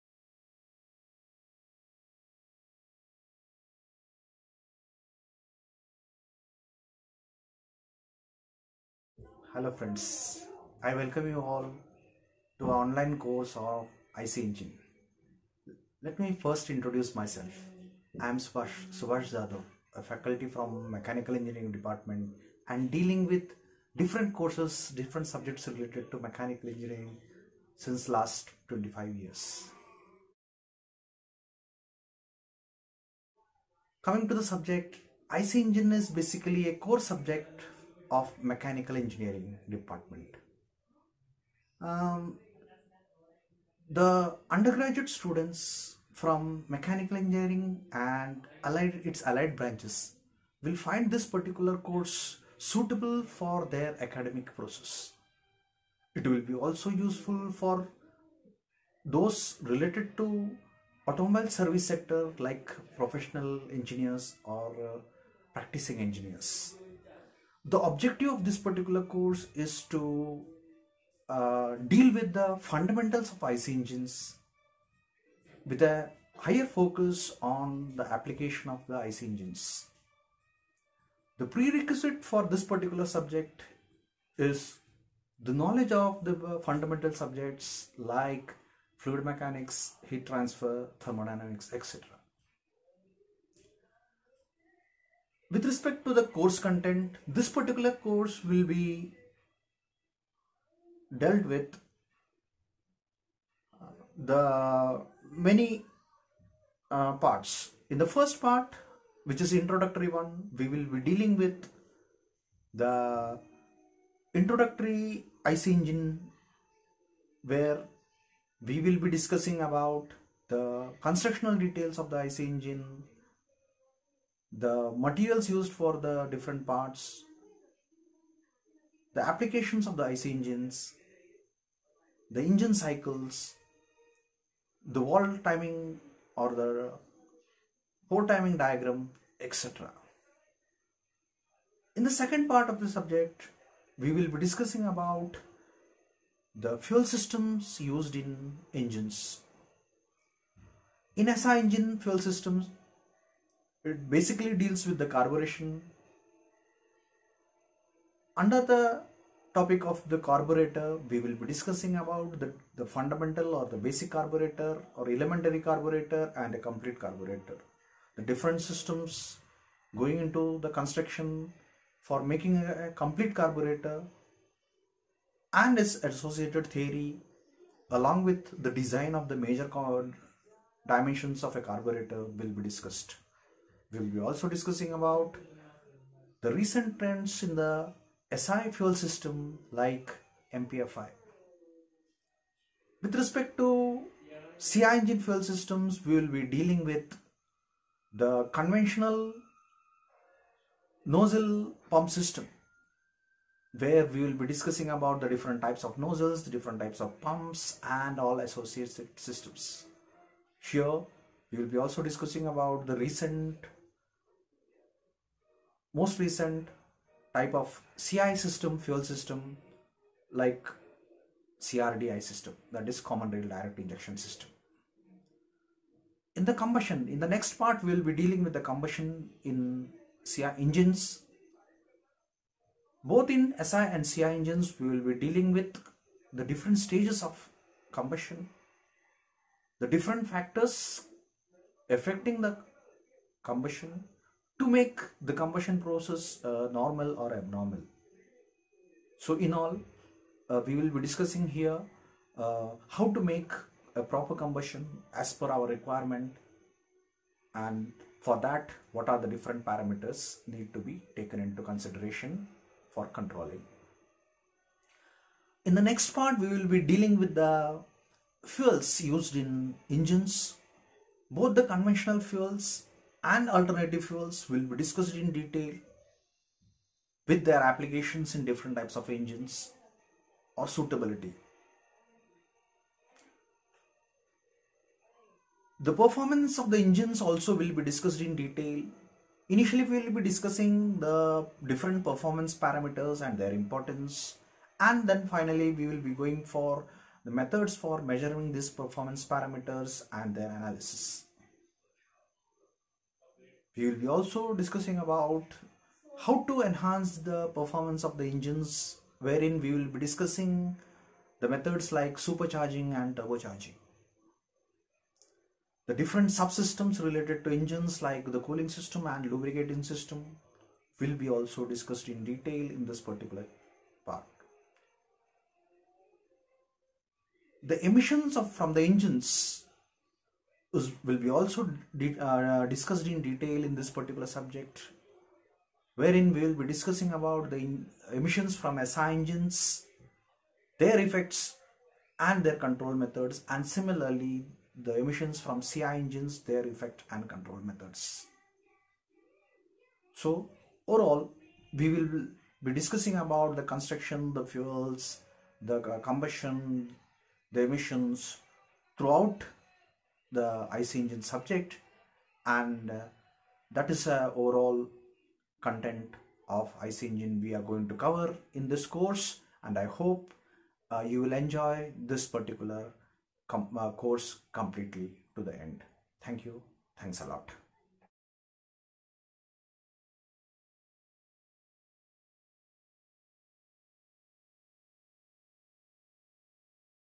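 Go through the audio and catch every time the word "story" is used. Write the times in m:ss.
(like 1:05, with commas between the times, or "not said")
not said.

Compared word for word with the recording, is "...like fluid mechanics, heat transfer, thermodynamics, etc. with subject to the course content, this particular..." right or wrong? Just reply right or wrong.
wrong.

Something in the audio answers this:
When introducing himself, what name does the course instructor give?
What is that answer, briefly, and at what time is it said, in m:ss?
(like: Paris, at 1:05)
Subhash Jadhav, at 0:18.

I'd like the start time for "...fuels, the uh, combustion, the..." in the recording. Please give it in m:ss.
5:54.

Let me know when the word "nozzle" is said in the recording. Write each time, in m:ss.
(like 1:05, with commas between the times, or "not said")
3:21, 3:25.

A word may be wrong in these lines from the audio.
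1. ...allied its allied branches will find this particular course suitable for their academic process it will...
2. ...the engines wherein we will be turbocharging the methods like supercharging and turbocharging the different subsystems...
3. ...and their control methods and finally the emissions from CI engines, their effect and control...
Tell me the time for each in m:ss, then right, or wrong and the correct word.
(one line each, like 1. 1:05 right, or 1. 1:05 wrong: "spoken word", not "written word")
1. 0:48 right
2. 5:08 wrong: "discussing", not "turbocharging"
3. 5:42 wrong: "similarly", not "finally".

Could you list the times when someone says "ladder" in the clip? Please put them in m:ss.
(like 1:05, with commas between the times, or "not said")
not said.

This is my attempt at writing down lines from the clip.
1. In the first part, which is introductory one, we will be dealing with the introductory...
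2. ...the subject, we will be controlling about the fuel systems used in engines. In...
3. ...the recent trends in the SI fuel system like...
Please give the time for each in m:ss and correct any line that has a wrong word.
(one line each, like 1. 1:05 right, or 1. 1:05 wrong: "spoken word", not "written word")
1. 1:47 right
2. 2:22 wrong: "discussing", not "controlling"
3. 3:06 right.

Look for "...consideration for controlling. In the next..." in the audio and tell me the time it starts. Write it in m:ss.
4:21.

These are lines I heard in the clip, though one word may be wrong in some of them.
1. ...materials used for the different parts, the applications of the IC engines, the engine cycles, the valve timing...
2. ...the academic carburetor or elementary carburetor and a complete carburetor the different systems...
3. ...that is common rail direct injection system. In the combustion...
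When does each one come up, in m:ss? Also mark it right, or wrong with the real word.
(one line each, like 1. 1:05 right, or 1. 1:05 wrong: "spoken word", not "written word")
1. 2:04 right
2. 2:43 wrong: "basic", not "academic"
3. 3:42 right.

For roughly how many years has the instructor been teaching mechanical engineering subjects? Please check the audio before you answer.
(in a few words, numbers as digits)
25 years.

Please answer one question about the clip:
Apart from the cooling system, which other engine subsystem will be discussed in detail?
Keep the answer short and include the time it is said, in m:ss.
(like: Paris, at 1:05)
lubricating system, at 5:19.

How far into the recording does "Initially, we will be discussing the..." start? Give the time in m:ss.
4:49.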